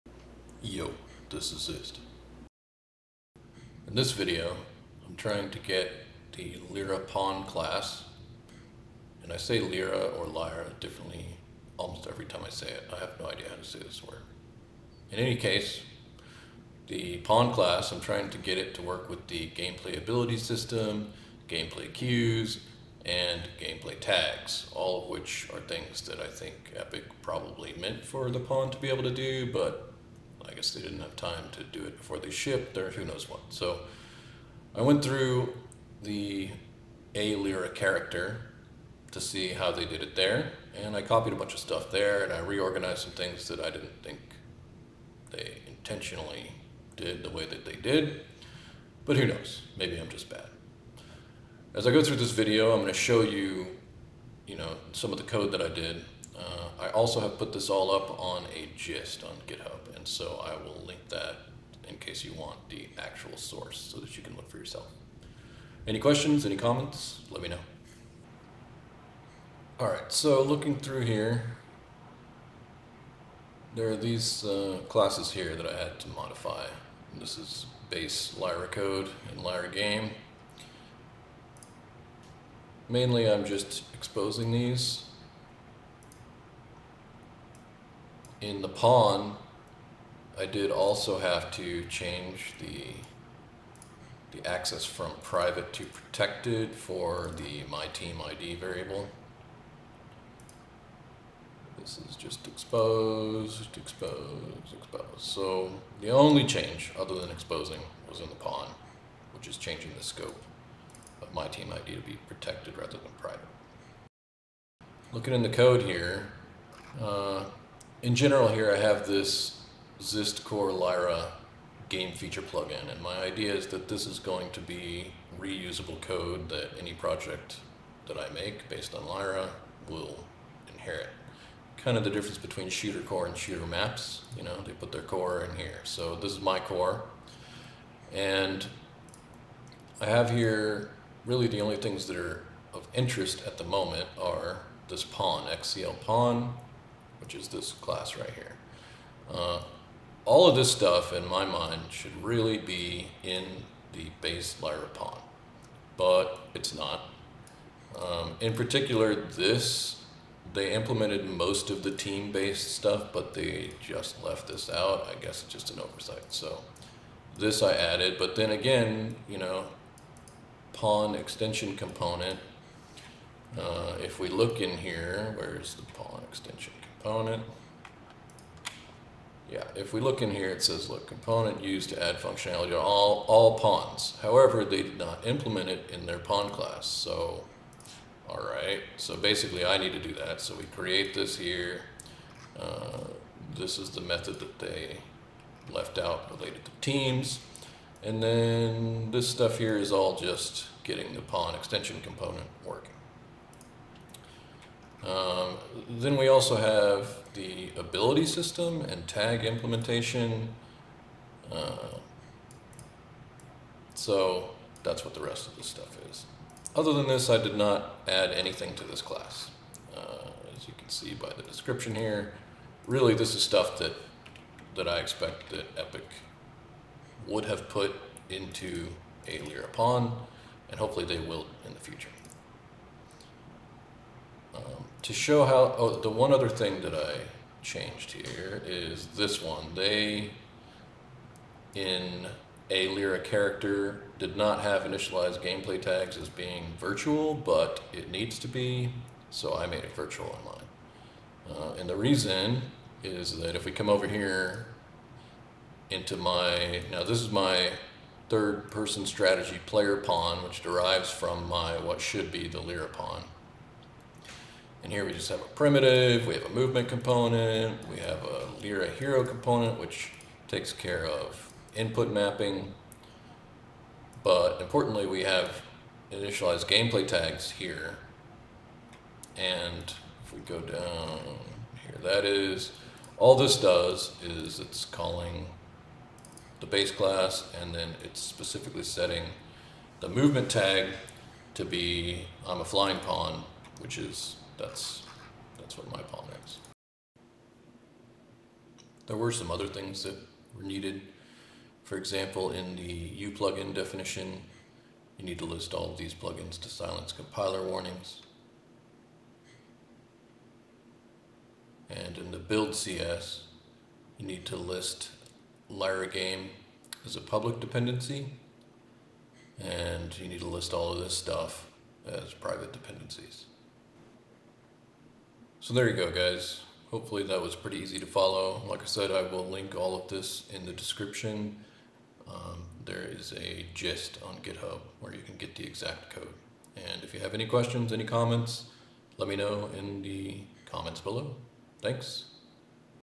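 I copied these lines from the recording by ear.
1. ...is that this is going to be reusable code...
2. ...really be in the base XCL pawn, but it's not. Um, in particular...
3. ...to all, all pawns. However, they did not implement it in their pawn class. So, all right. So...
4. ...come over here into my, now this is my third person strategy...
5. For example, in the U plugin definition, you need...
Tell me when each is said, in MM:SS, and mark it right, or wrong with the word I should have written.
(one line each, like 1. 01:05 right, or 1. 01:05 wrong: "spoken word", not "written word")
1. 02:03 right
2. 02:32 wrong: "Lyra", not "XCL"
3. 03:02 right
4. 04:13 right
5. 05:01 right.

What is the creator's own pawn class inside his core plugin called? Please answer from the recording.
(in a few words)
XCL pawn.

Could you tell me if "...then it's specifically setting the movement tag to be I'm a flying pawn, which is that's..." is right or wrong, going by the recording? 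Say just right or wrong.
right.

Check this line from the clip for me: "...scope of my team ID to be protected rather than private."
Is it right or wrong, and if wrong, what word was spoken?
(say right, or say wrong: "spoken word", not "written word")
right.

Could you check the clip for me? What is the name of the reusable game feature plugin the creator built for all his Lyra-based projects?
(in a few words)
Xist Core Lyra.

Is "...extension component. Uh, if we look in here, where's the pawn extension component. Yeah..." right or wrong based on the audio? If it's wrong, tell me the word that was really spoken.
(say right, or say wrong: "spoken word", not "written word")
right.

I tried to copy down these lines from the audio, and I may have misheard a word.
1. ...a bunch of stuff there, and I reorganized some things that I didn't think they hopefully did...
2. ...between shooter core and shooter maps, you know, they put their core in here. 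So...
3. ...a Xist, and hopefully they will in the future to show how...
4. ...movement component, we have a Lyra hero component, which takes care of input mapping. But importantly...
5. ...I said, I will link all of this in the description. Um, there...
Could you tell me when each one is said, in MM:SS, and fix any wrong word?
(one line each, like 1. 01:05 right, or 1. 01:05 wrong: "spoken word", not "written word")
1. 00:41 wrong: "intentionally", not "hopefully"
2. 02:12 right
3. 03:49 wrong: "LyraPawn", not "Xist"
4. 04:26 right
5. 05:28 right.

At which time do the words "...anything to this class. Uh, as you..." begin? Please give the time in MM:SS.
03:38.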